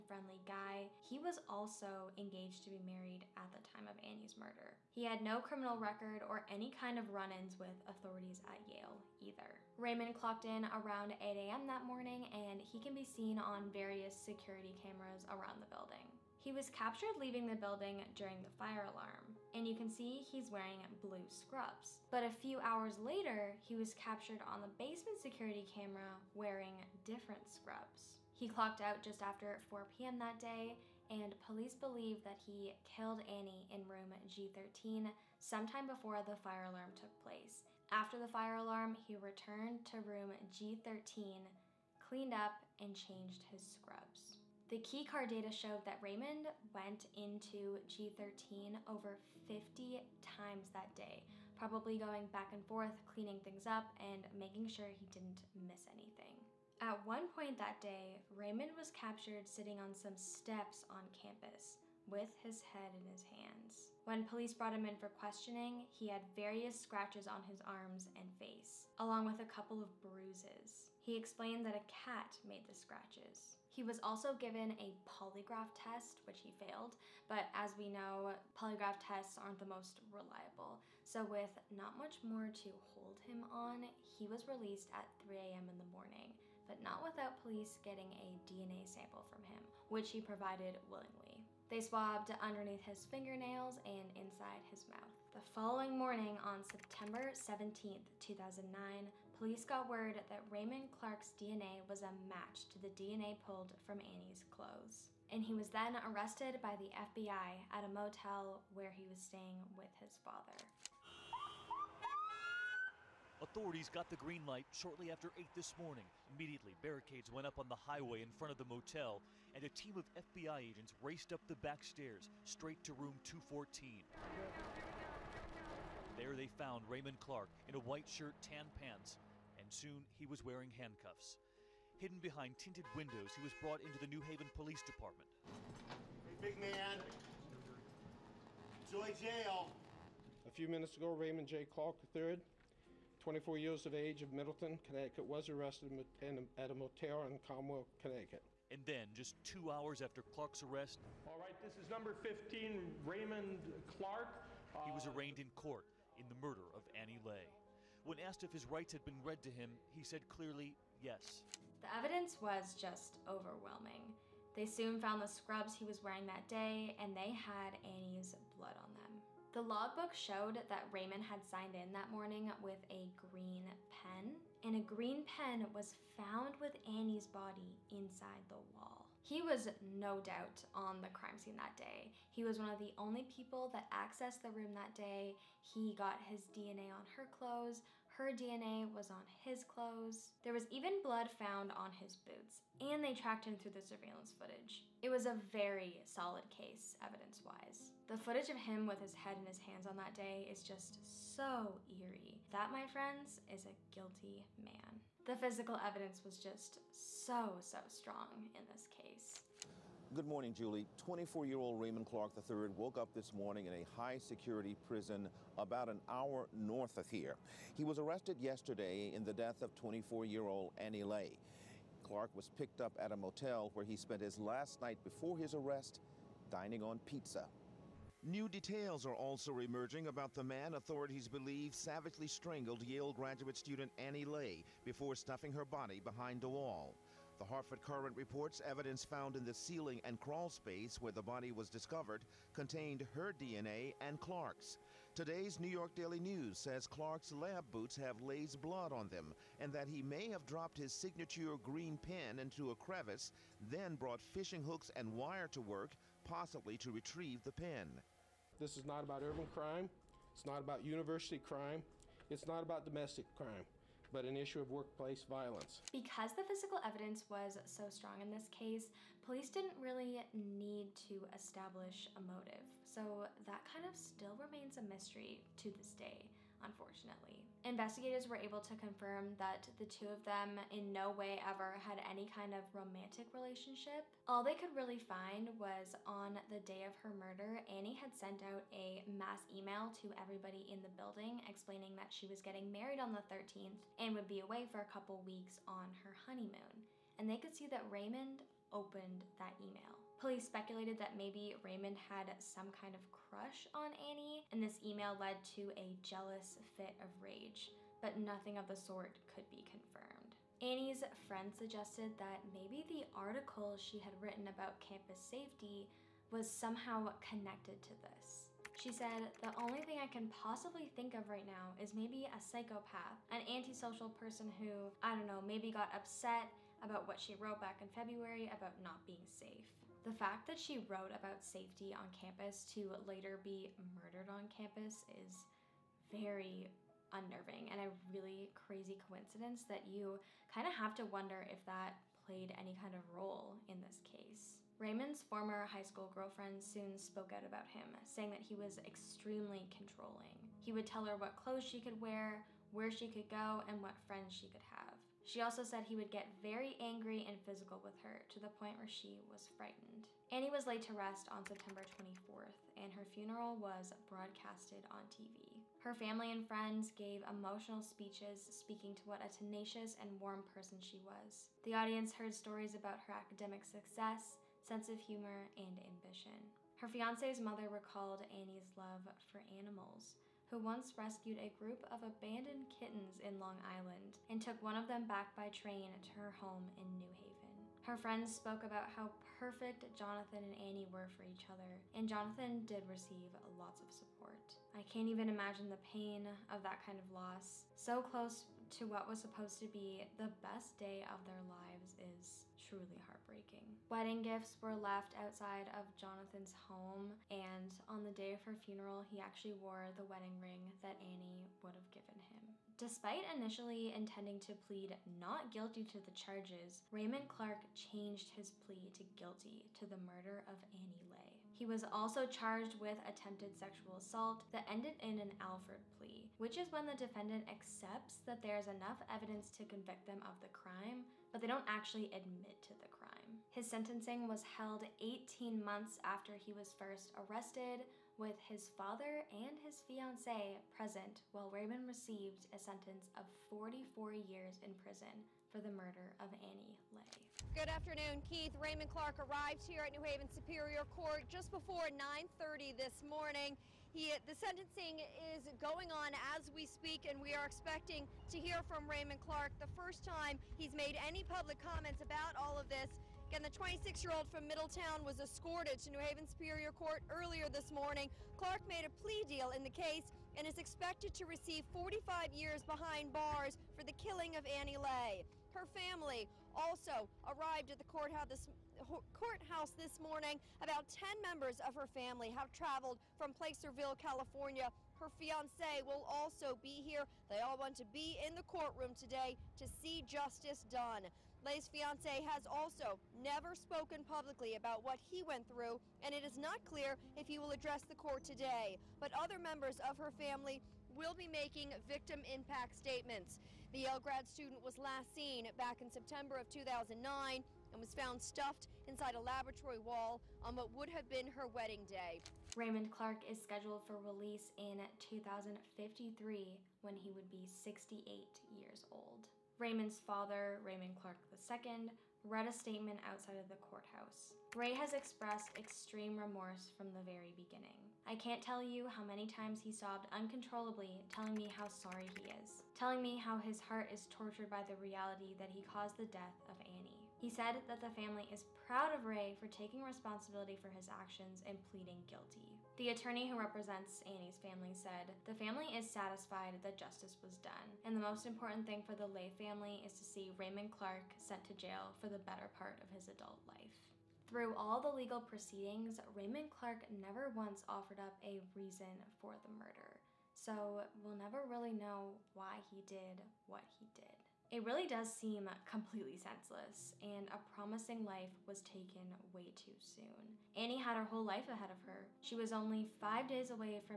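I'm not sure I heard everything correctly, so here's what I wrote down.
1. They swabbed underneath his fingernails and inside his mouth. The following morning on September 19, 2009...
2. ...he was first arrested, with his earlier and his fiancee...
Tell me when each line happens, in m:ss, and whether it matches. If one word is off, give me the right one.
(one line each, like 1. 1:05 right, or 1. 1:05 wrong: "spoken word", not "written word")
1. 1:31 wrong: "17", not "19"
2. 7:16 wrong: "father", not "earlier".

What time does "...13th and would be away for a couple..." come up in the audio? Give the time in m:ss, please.
4:53.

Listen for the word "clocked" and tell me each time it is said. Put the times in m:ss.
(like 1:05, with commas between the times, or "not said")
0:10, 0:28.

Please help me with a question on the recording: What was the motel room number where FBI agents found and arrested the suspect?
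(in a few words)
214.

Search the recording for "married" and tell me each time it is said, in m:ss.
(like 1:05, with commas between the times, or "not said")
0:02, 4:52.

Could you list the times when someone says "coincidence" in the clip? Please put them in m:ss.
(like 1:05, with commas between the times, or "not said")
5:38.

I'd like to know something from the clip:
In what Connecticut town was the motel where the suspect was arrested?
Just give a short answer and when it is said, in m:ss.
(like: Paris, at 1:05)
Cromwell, at 2:27.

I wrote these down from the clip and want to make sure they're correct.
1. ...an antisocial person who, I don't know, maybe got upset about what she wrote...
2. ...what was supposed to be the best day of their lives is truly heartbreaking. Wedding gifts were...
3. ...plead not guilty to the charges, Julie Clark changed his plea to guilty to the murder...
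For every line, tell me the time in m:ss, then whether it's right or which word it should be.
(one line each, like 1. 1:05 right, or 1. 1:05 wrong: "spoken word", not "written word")
1. 5:23 right
2. 6:38 right
3. 6:54 wrong: "Raymond", not "Julie".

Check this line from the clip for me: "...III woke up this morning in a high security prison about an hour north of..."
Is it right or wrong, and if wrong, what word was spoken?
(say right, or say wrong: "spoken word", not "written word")
right.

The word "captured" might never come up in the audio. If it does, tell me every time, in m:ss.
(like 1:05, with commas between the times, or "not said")
0:16, 0:23, 0:58.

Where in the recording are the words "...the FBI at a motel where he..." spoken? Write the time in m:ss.
1:46.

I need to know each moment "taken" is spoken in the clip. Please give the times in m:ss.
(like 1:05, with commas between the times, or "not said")
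9:28.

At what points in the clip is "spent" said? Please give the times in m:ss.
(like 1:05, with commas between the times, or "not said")
3:43.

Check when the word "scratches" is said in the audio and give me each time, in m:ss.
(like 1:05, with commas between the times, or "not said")
1:06, 1:12.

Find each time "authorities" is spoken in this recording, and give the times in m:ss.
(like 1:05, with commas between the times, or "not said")
0:07, 1:53, 3:50.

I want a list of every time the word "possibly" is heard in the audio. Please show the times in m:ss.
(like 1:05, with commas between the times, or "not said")
4:16, 5:20.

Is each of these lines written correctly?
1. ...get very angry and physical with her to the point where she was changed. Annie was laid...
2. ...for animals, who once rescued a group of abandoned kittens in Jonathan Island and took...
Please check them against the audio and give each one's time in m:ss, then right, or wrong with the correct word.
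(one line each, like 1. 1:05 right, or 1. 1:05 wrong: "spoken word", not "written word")
1. 5:56 wrong: "frightened", not "changed"
2. 6:19 wrong: "Long", not "Jonathan".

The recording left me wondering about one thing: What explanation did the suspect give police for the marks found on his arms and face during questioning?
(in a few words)
A cat.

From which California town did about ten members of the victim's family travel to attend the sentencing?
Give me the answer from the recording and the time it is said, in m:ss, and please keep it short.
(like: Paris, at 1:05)
Placerville, at 8:03.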